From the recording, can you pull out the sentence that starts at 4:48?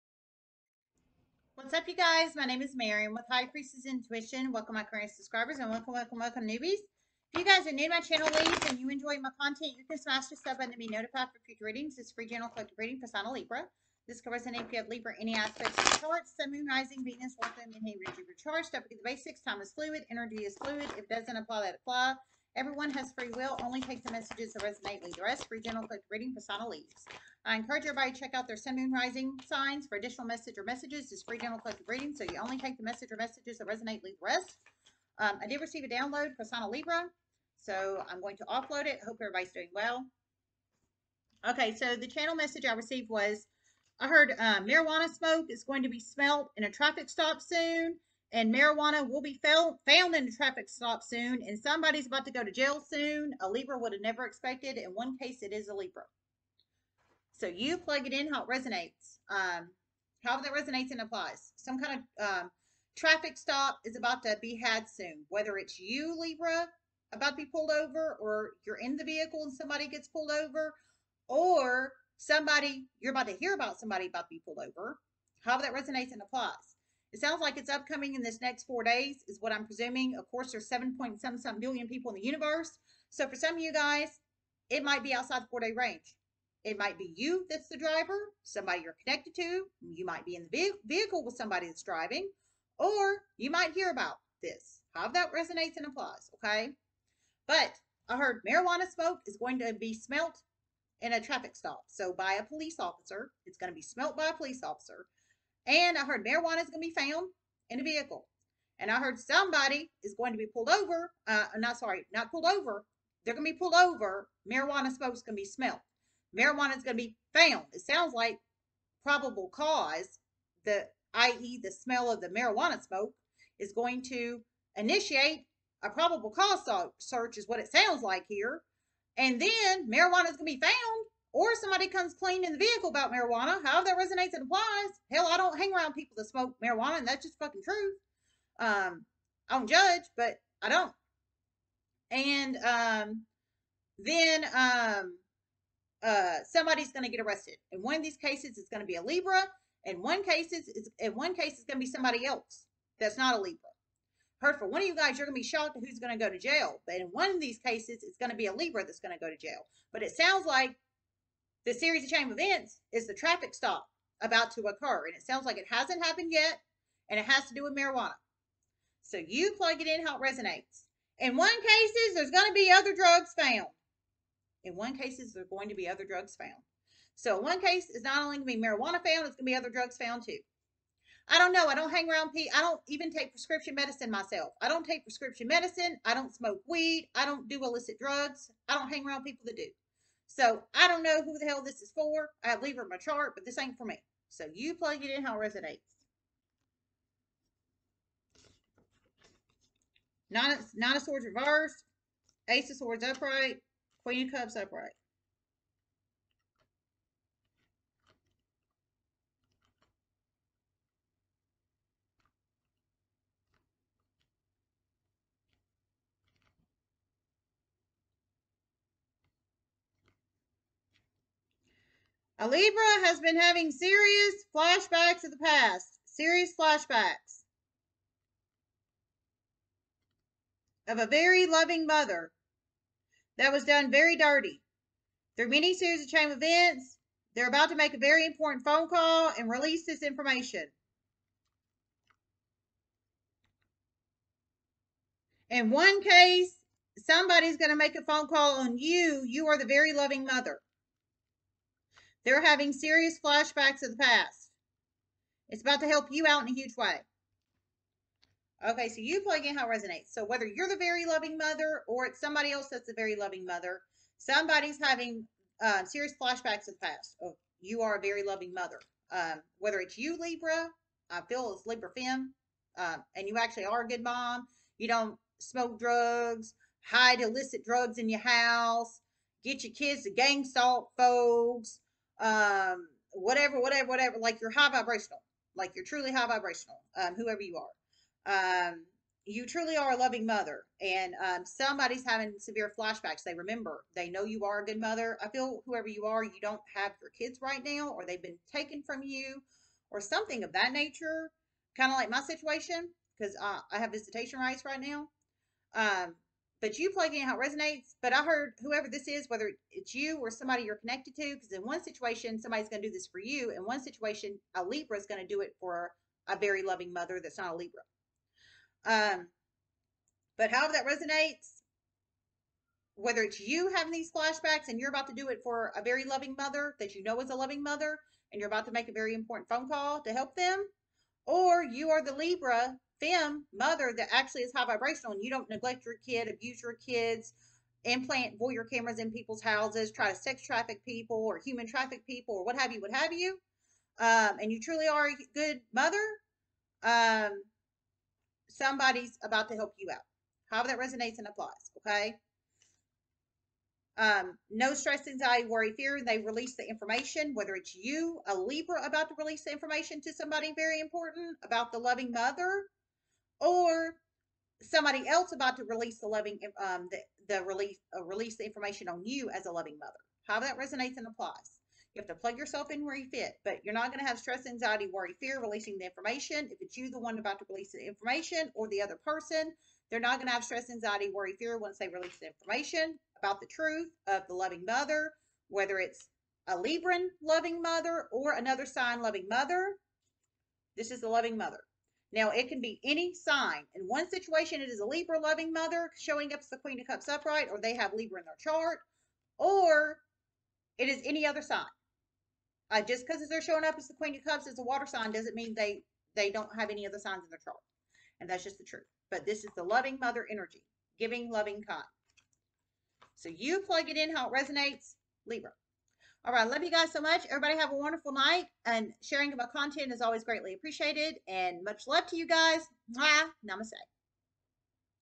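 Um, you truly are a loving mother, and um, somebody's having severe flashbacks.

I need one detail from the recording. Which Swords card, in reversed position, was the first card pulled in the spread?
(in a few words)
Nine of Swords.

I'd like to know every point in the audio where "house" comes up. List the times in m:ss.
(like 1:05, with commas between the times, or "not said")
4:38, 5:39.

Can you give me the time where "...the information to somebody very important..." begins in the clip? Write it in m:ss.
5:59.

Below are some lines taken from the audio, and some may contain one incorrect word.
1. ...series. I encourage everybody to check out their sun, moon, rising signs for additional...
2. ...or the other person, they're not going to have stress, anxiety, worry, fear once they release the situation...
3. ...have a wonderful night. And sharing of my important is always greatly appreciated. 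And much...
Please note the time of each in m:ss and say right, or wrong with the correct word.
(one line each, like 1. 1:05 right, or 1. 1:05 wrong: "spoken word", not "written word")
1. 0:26 wrong: "leaves", not "series"
2. 6:18 wrong: "information", not "situation"
3. 6:57 wrong: "content", not "important".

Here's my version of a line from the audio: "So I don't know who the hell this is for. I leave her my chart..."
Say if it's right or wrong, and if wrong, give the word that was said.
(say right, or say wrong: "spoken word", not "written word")
right.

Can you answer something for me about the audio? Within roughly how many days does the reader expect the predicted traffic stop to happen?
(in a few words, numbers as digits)
4.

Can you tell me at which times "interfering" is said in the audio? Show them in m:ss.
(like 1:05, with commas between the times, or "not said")
not said.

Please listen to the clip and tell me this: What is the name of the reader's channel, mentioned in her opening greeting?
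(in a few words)
High Priestess Intuition.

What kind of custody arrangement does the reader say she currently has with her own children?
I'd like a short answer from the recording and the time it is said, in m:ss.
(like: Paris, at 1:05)
Visitation rights, at 5:03.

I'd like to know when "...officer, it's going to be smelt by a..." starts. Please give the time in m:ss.
1:42.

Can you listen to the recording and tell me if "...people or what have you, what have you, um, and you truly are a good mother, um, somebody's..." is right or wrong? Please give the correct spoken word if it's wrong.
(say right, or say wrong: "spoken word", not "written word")
right.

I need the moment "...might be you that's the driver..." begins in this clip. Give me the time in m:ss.
1:26.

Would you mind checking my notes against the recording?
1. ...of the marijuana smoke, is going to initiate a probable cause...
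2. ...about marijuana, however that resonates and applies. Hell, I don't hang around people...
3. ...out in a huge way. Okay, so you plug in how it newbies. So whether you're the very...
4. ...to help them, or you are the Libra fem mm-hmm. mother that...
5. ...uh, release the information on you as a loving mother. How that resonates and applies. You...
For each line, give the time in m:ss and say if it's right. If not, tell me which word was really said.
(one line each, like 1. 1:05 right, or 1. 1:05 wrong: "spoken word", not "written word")
1. 2:02 right
2. 2:12 right
3. 4:16 wrong: "resonates", not "newbies"
4. 5:30 right
5. 6:07 right.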